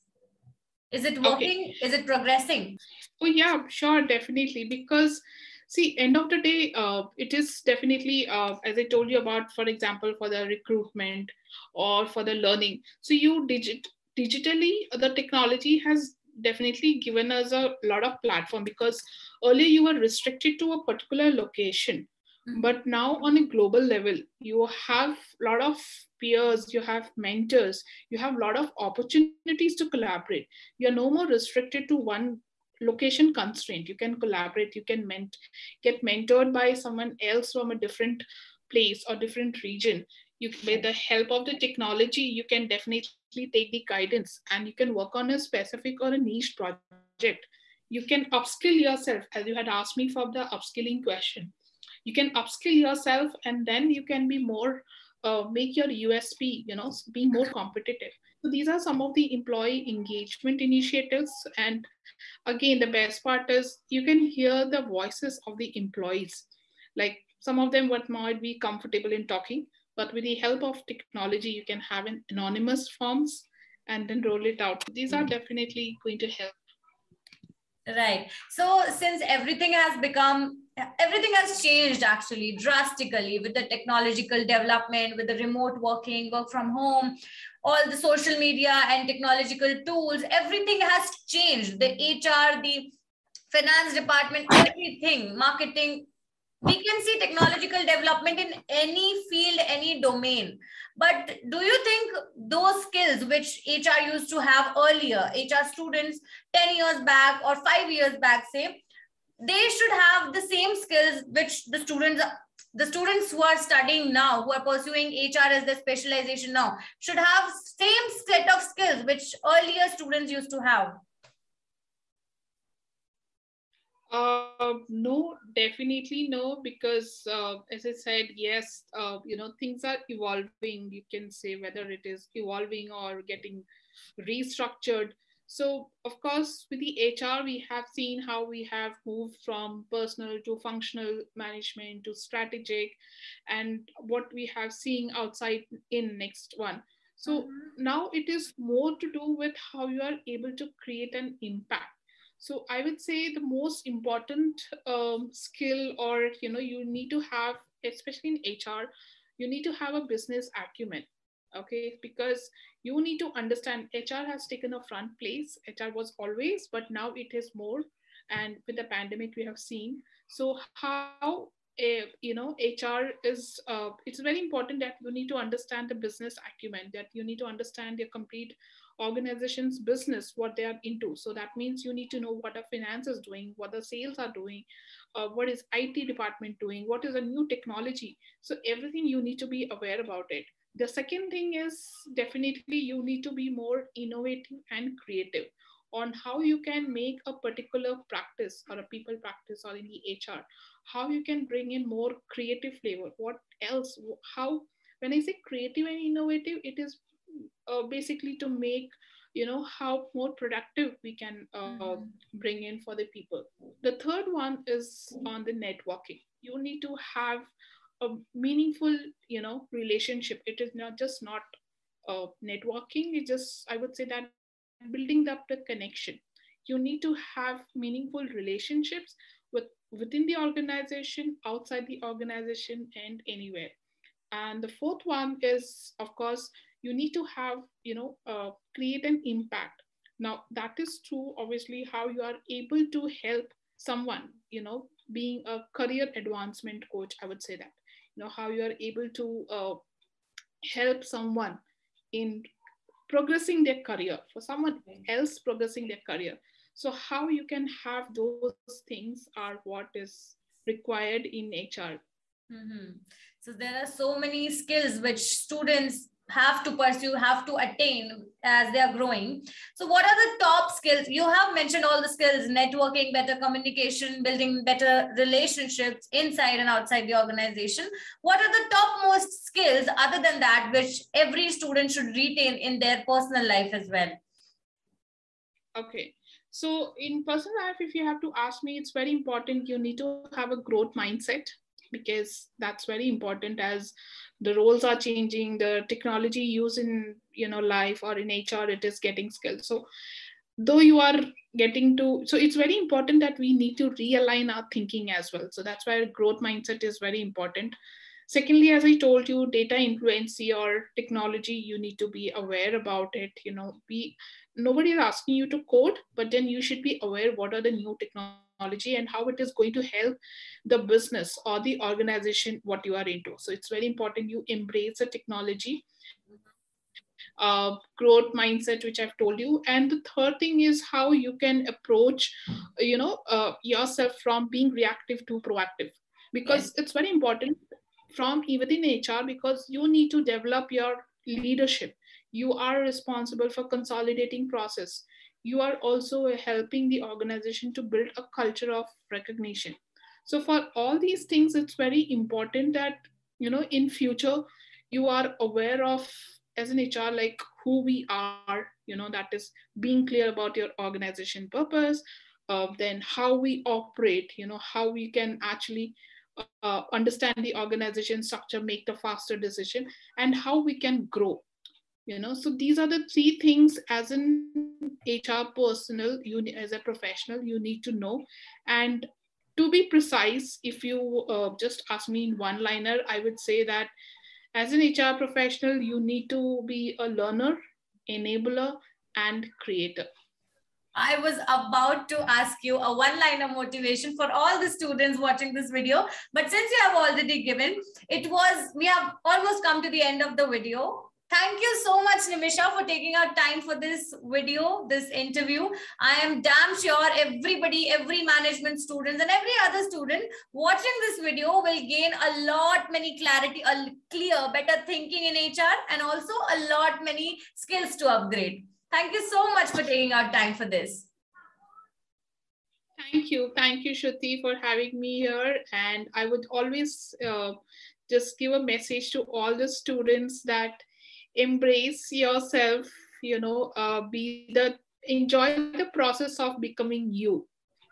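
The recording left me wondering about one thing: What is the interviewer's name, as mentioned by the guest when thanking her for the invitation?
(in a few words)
Shruti.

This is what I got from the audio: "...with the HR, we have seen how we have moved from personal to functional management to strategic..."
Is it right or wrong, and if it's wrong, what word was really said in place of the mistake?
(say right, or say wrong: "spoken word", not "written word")
right.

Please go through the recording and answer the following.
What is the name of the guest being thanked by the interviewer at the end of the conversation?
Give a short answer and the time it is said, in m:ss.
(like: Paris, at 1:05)
Nimisha, at 6:42.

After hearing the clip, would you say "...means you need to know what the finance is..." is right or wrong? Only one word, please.
right.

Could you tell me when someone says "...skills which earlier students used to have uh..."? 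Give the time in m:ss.
1:58.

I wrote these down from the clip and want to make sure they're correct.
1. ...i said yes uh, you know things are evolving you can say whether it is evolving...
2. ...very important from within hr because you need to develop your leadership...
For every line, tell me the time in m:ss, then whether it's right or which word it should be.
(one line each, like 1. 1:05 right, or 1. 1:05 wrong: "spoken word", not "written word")
1. 2:07 right
2. 5:36 right.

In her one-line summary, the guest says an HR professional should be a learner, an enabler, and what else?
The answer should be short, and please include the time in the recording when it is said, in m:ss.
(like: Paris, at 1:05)
Creator, at 6:29.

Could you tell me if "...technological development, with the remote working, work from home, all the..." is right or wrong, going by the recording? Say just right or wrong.
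right.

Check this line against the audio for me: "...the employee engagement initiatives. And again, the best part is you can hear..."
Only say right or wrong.
right.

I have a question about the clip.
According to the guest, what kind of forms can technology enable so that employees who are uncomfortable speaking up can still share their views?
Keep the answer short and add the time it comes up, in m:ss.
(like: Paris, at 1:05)
Anonymous forms, at 1:12.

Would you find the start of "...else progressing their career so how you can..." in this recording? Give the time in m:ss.
4:15.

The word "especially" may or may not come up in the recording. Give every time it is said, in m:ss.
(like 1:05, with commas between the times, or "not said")
2:37.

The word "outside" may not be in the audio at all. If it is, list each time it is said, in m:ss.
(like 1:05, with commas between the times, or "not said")
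2:25, 3:51, 4:36.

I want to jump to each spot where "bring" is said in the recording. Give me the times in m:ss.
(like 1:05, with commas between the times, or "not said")
3:21, 3:32.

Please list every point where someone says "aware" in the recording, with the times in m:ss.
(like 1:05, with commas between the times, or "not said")
3:09, 5:12, 5:17, 5:55.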